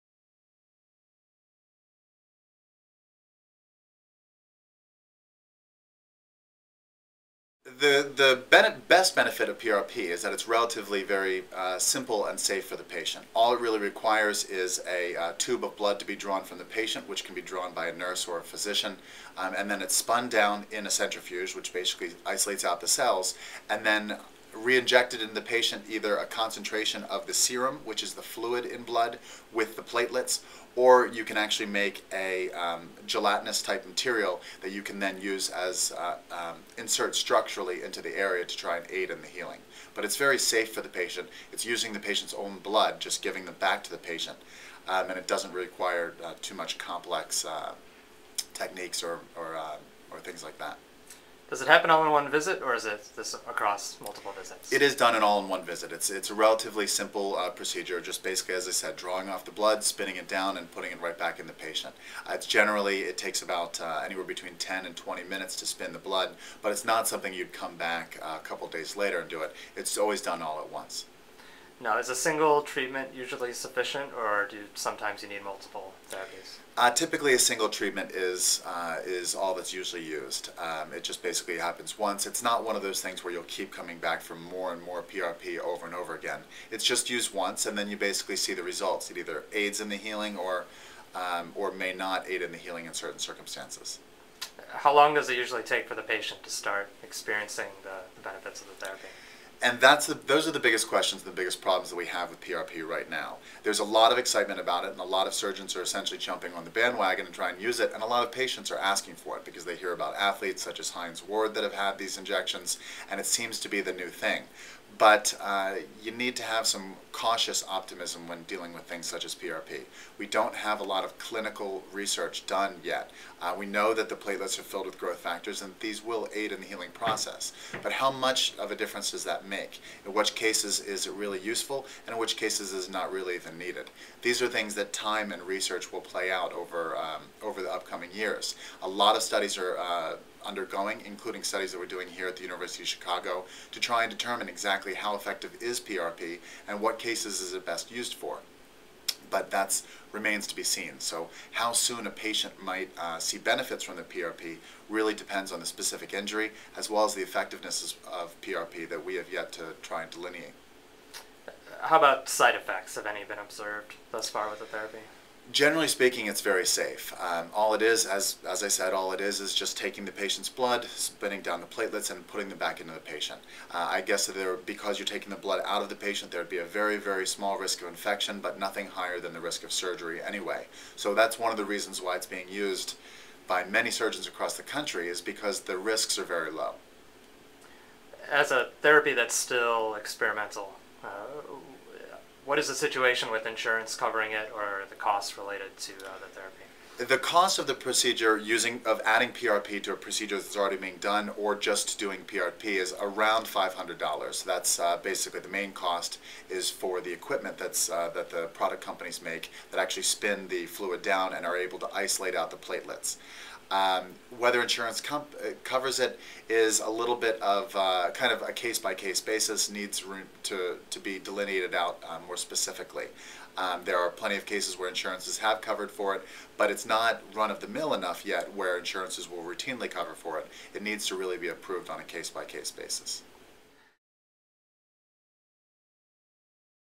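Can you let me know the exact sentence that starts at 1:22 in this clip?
It's not one of those things where you'll keep coming back for more and more PRP over and over again.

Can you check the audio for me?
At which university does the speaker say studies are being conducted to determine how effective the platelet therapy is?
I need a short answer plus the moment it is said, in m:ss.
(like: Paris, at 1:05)
University of Chicago, at 2:22.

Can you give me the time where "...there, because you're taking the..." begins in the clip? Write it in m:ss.
2:54.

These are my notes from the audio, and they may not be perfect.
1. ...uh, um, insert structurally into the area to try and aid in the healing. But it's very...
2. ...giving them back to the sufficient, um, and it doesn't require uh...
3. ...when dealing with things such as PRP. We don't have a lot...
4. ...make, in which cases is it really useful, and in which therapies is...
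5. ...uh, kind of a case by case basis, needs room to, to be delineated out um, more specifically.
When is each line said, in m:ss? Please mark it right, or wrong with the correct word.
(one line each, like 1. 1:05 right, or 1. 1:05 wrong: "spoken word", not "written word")
1. 0:35 right
2. 0:43 wrong: "patient", not "sufficient"
3. 1:58 right
4. 2:09 wrong: "cases", not "therapies"
5. 3:37 right.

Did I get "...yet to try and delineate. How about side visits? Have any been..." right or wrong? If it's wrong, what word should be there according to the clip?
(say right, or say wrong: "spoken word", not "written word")
wrong: "effects", not "visits".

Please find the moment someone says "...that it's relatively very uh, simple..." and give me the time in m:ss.
0:10.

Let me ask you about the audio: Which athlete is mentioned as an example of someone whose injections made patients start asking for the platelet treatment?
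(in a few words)
Hines Ward.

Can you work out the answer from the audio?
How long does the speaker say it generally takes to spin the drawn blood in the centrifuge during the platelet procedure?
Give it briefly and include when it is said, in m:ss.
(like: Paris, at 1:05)
10 to 20 minutes, at 1:04.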